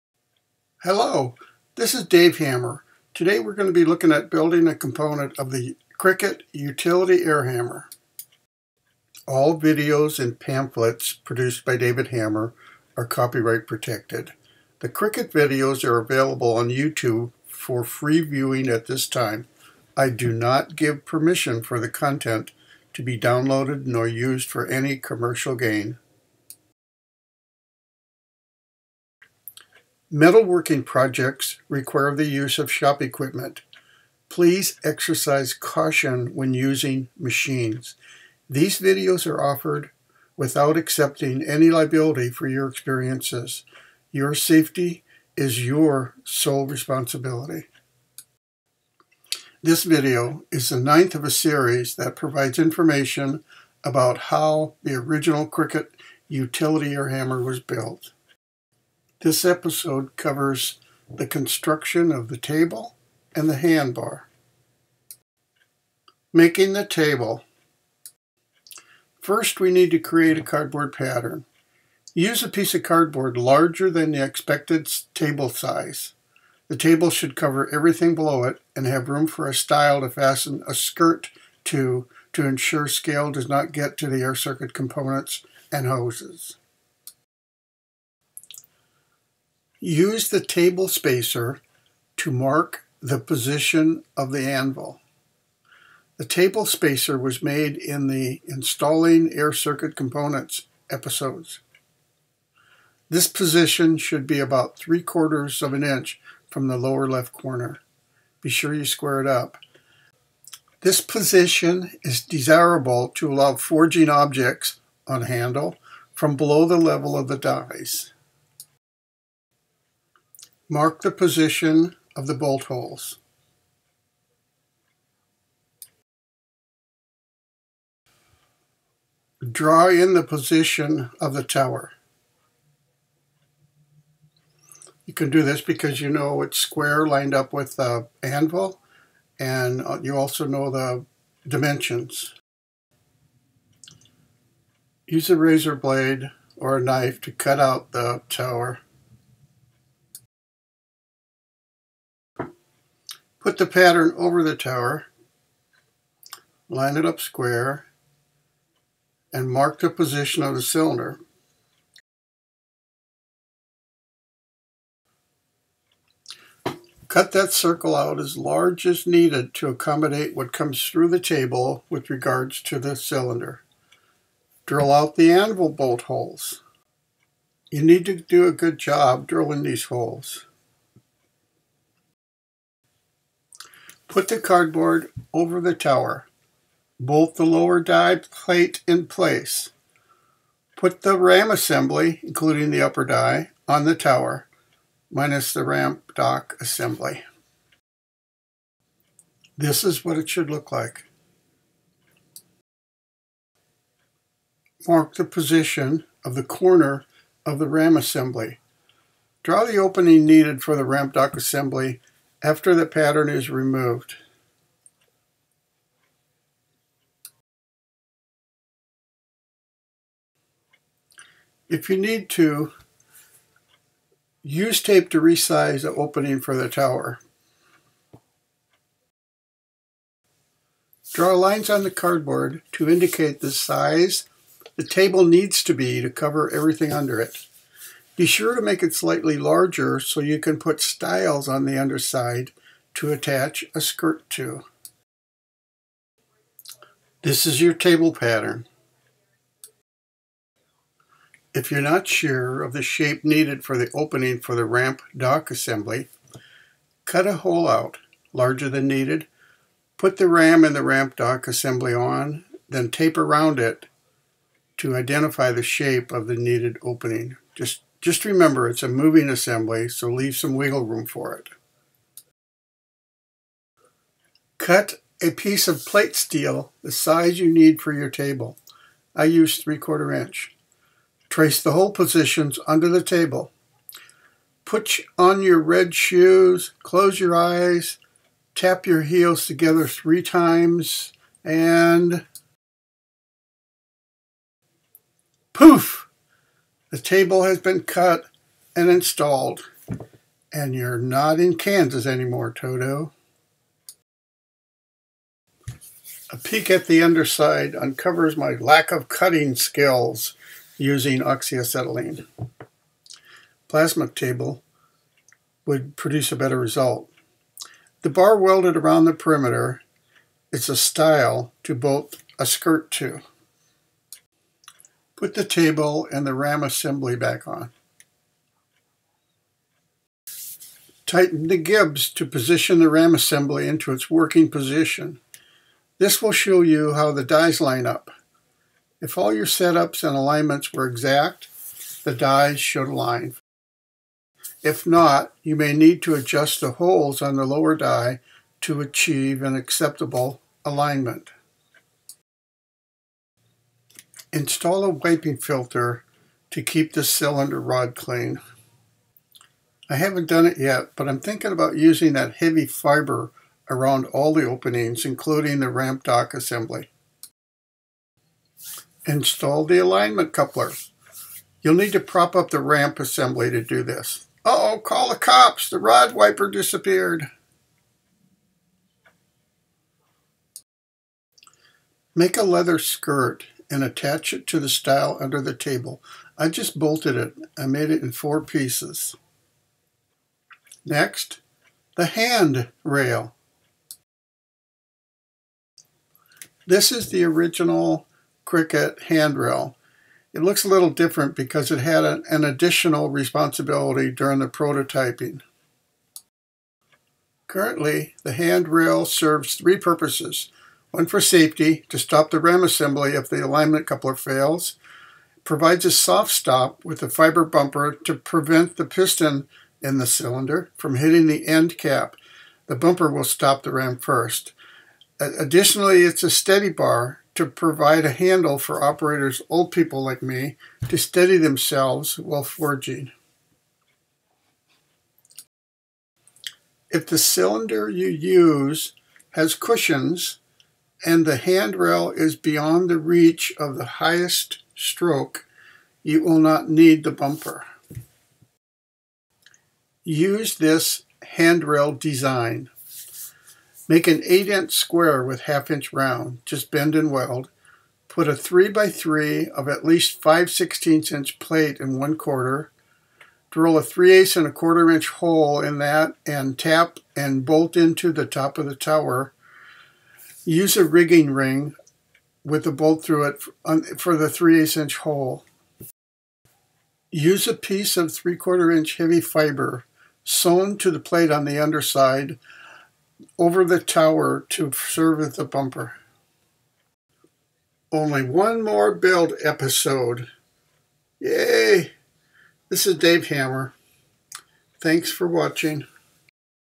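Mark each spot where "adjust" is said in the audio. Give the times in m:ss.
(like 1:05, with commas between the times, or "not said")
5:46.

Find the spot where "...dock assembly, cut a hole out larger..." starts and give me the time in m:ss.
4:15.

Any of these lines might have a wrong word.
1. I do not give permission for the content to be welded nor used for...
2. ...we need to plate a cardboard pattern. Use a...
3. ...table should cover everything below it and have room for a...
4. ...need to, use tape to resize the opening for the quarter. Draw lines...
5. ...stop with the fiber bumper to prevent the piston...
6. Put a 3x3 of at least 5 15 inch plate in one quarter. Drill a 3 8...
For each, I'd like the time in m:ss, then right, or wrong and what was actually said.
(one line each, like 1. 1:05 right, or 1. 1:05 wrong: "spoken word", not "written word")
1. 0:19 wrong: "downloaded", not "welded"
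2. 1:09 wrong: "create", not "plate"
3. 1:16 right
4. 3:41 wrong: "tower", not "quarter"
5. 6:56 right
6. 7:38 wrong: "16", not "15".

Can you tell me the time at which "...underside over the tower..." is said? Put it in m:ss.
8:01.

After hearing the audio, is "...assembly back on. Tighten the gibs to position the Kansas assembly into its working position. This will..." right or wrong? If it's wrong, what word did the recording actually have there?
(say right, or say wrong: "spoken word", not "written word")
wrong: "RAM", not "Kansas".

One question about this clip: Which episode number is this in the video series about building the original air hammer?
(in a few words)
ninth.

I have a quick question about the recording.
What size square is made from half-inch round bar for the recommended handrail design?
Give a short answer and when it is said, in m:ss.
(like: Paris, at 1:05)
8-inch, at 7:34.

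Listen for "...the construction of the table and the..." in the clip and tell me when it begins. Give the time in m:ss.
1:01.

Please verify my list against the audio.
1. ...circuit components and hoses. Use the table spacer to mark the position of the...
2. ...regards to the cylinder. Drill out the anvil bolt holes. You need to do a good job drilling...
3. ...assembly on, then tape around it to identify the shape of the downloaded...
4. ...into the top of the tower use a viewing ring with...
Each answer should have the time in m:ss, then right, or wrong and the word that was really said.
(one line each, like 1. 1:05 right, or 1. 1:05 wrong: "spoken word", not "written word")
1. 1:24 right
2. 2:52 right
3. 4:21 wrong: "needed", not "downloaded"
4. 7:47 wrong: "rigging", not "viewing".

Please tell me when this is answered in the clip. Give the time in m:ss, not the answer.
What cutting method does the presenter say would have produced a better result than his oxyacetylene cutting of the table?
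5:13.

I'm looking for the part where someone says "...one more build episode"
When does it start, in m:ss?
8:08.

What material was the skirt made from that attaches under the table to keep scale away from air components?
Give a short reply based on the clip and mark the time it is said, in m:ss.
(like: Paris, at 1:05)
leather, at 6:22.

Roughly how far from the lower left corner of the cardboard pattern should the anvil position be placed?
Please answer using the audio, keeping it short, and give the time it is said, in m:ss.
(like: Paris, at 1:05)
3/4 inch, at 1:44.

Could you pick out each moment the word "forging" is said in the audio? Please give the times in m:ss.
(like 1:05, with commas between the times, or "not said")
1:53, 7:12.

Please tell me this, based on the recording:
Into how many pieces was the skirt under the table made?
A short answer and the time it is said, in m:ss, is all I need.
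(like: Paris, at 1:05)
four, at 6:28.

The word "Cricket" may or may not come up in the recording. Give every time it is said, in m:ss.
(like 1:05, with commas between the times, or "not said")
0:05, 0:14, 0:55, 6:38.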